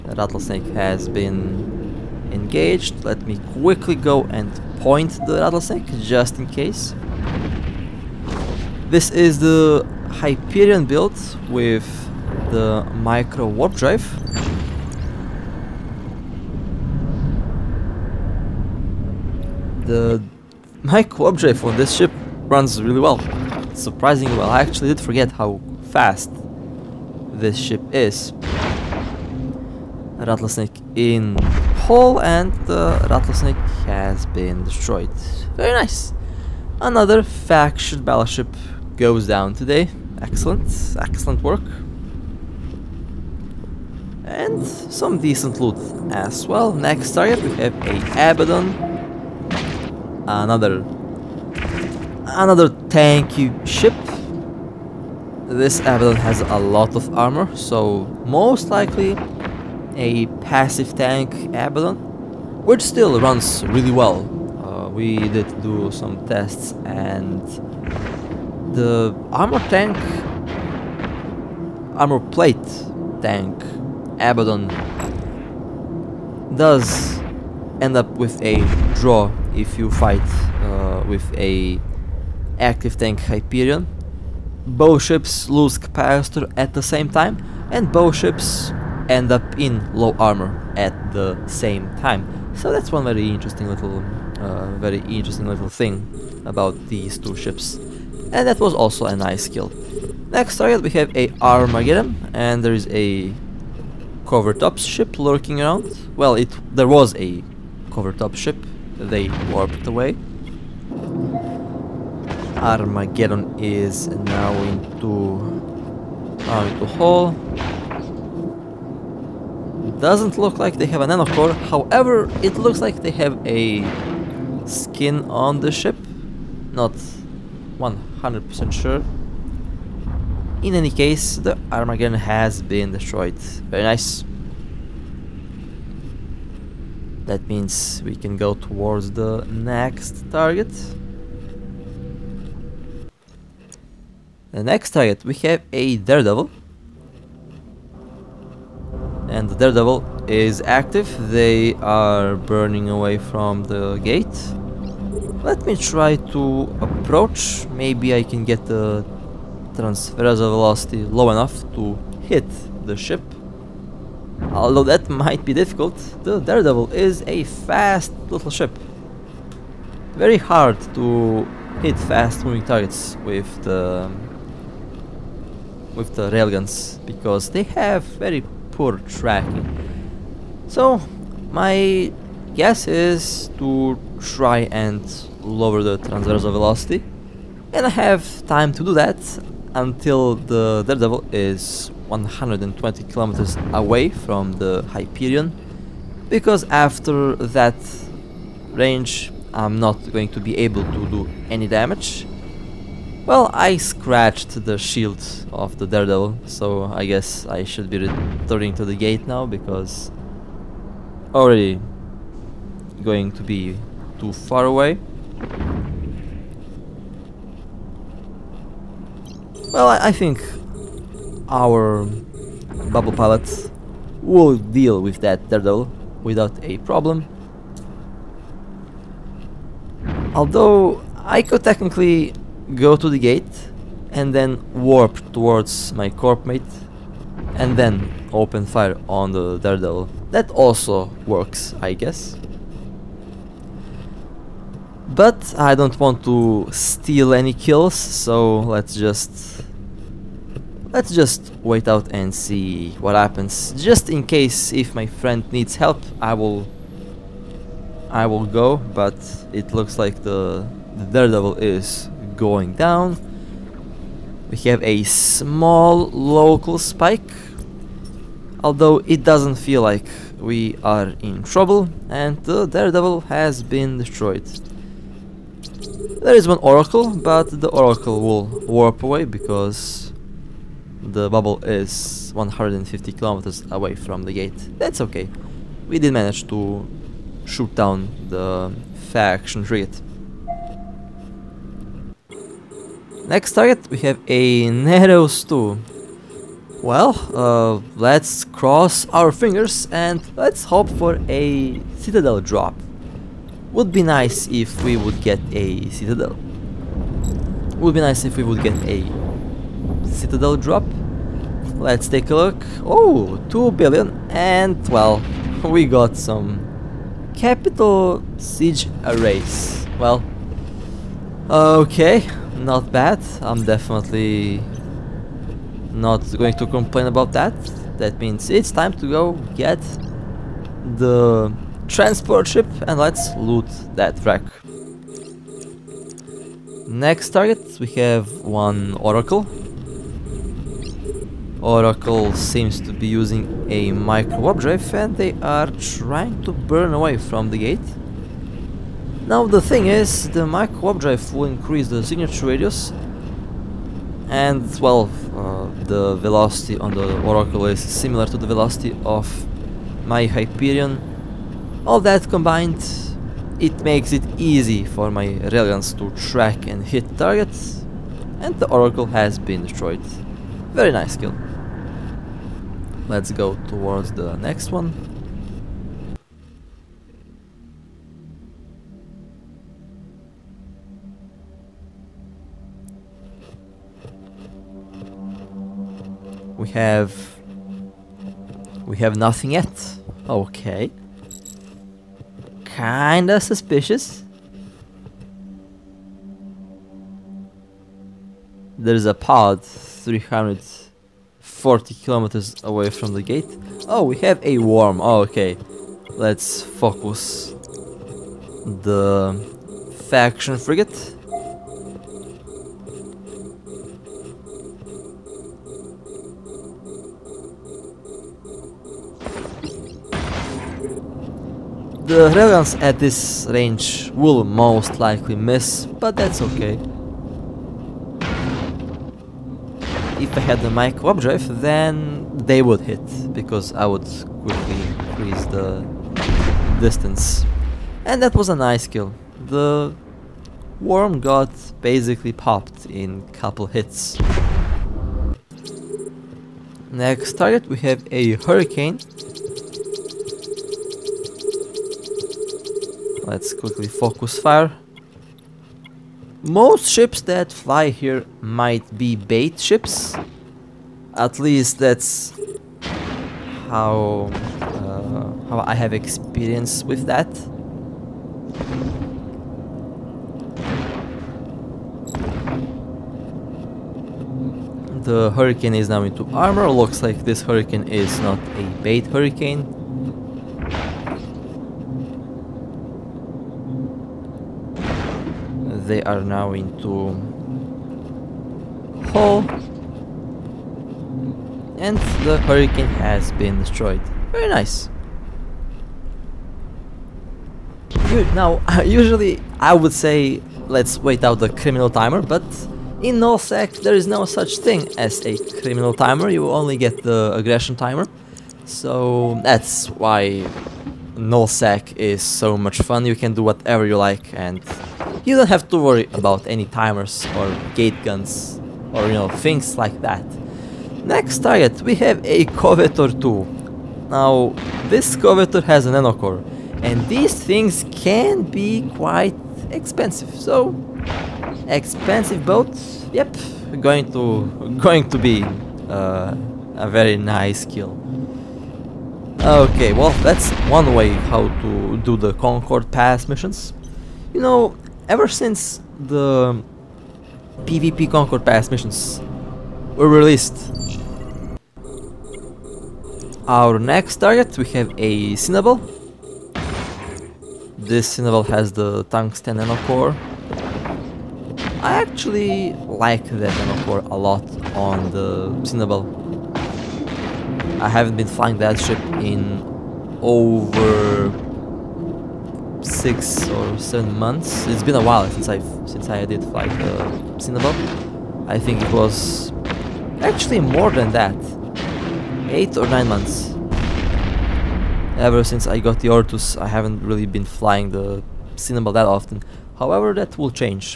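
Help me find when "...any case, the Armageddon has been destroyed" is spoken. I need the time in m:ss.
2:10.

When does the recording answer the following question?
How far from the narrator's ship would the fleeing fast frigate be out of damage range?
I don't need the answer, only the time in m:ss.
3:12.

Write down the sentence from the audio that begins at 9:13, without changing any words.
Our next target, we have a Cynabal.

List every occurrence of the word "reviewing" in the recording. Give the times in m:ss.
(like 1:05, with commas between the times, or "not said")
not said.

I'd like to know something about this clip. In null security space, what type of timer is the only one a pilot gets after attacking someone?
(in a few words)
Aggression timer.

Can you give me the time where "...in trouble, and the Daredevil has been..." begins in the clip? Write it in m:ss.
4:31.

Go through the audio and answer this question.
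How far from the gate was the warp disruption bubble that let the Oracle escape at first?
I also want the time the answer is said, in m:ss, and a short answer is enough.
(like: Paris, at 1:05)
150 kilometers, at 4:42.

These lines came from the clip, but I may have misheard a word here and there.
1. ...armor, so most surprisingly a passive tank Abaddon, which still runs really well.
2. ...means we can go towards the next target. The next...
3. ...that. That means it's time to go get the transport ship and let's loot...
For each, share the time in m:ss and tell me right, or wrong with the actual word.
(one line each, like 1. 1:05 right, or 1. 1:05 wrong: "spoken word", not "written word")
1. 0:57 wrong: "likely", not "surprisingly"
2. 2:17 right
3. 5:27 right.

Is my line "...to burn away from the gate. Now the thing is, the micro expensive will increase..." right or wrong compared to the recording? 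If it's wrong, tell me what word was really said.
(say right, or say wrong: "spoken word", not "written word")
wrong: "drive", not "expensive".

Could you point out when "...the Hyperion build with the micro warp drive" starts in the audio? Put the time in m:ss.
0:09.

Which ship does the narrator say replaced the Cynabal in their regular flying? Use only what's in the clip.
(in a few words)
Orthrus.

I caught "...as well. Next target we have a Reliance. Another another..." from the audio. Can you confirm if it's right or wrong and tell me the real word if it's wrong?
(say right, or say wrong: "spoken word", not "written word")
wrong: "Abaddon", not "Reliance".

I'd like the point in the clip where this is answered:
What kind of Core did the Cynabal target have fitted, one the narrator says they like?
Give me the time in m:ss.
9:19.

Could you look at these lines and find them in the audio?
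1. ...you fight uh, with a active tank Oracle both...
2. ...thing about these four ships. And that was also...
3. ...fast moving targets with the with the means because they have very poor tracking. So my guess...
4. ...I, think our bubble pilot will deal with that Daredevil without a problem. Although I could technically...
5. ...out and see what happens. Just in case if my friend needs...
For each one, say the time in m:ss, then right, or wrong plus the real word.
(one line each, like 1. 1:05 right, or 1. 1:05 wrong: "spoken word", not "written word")
1. 1:19 wrong: "Hyperion", not "Oracle"
2. 1:35 wrong: "two", not "four"
3. 2:51 wrong: "railguns", not "means"
4. 3:39 right
5. 4:11 right.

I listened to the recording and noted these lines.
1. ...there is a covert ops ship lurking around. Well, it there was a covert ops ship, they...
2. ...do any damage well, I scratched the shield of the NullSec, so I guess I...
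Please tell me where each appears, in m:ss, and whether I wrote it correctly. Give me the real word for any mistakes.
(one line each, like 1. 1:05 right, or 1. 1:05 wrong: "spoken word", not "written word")
1. 1:42 right
2. 3:21 wrong: "Daredevil", not "NullSec".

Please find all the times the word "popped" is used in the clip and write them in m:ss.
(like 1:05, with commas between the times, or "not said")
7:22.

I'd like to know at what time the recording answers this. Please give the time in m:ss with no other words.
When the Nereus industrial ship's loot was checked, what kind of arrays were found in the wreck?
5:17.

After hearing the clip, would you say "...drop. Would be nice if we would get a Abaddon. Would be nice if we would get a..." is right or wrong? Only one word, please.
wrong.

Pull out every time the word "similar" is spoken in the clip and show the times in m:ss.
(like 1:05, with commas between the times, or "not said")
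5:57.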